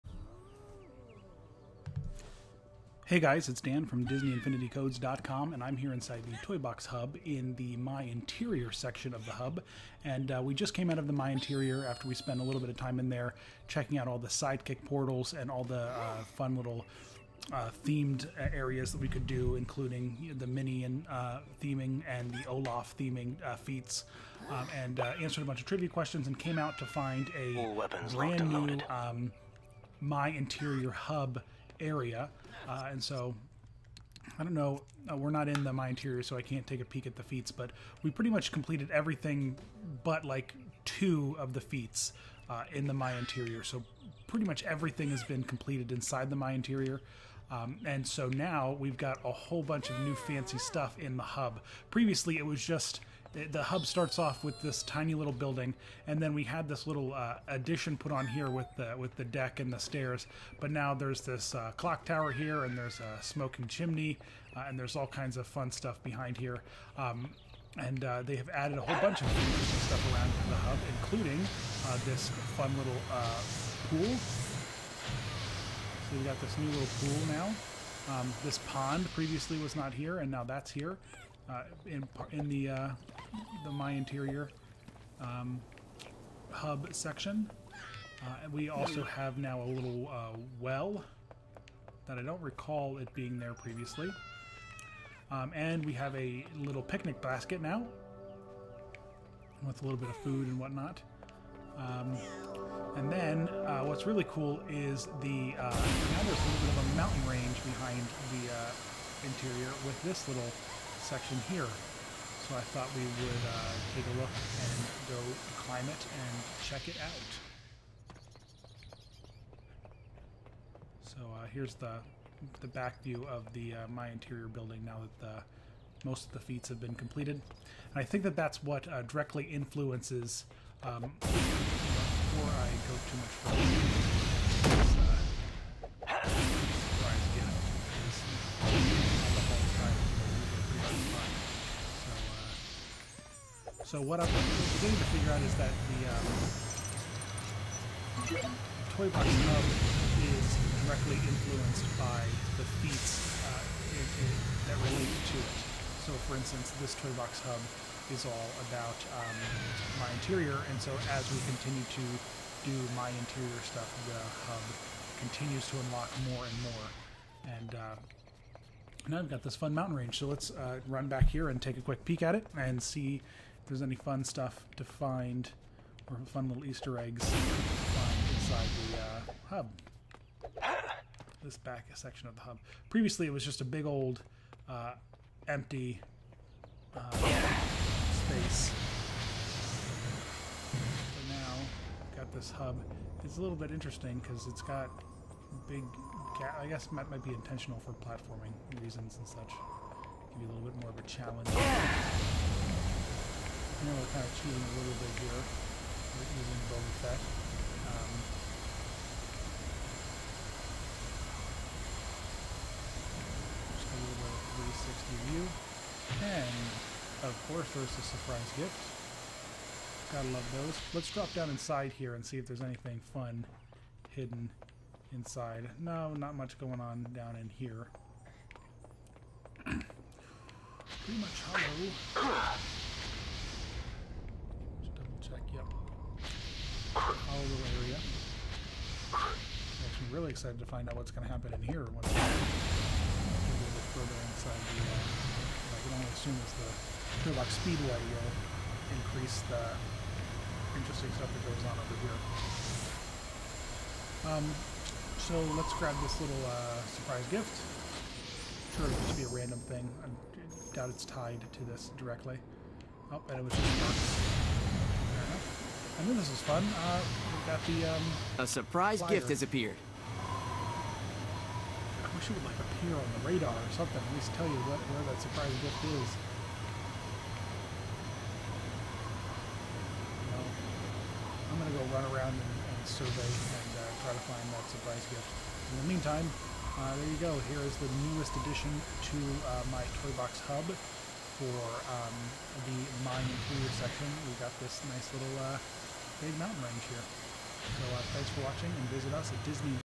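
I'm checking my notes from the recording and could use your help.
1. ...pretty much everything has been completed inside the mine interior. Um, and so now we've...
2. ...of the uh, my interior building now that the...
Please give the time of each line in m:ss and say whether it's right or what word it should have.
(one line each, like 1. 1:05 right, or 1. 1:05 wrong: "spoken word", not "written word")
1. 0:44 right
2. 2:03 right.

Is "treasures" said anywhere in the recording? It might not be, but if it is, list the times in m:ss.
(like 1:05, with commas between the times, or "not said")
not said.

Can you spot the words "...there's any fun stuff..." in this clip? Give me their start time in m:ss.
2:53.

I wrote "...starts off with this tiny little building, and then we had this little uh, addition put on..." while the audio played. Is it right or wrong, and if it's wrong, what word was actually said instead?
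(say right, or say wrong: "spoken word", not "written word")
right.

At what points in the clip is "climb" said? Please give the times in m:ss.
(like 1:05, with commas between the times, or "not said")
1:55.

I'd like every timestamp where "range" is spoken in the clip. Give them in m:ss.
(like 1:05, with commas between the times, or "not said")
1:47, 2:49, 4:56.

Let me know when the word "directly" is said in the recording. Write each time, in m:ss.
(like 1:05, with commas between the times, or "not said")
2:09, 2:30, 4:21.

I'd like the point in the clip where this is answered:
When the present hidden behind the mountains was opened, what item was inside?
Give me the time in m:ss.
4:28.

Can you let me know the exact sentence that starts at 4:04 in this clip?
Uh, I can only assume as the Turlock Speedway will uh, increase the interesting stuff that goes on over here.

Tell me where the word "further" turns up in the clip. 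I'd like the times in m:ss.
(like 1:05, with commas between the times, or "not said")
2:14, 4:03.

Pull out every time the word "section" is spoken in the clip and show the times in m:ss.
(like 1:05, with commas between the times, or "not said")
0:08, 1:26, 1:51, 3:01, 4:53.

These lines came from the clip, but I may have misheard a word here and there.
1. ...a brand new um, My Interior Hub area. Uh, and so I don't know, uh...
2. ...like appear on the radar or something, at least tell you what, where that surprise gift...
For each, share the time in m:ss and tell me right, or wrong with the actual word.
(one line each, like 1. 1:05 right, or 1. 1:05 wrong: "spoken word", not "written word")
1. 0:27 right
2. 4:32 right.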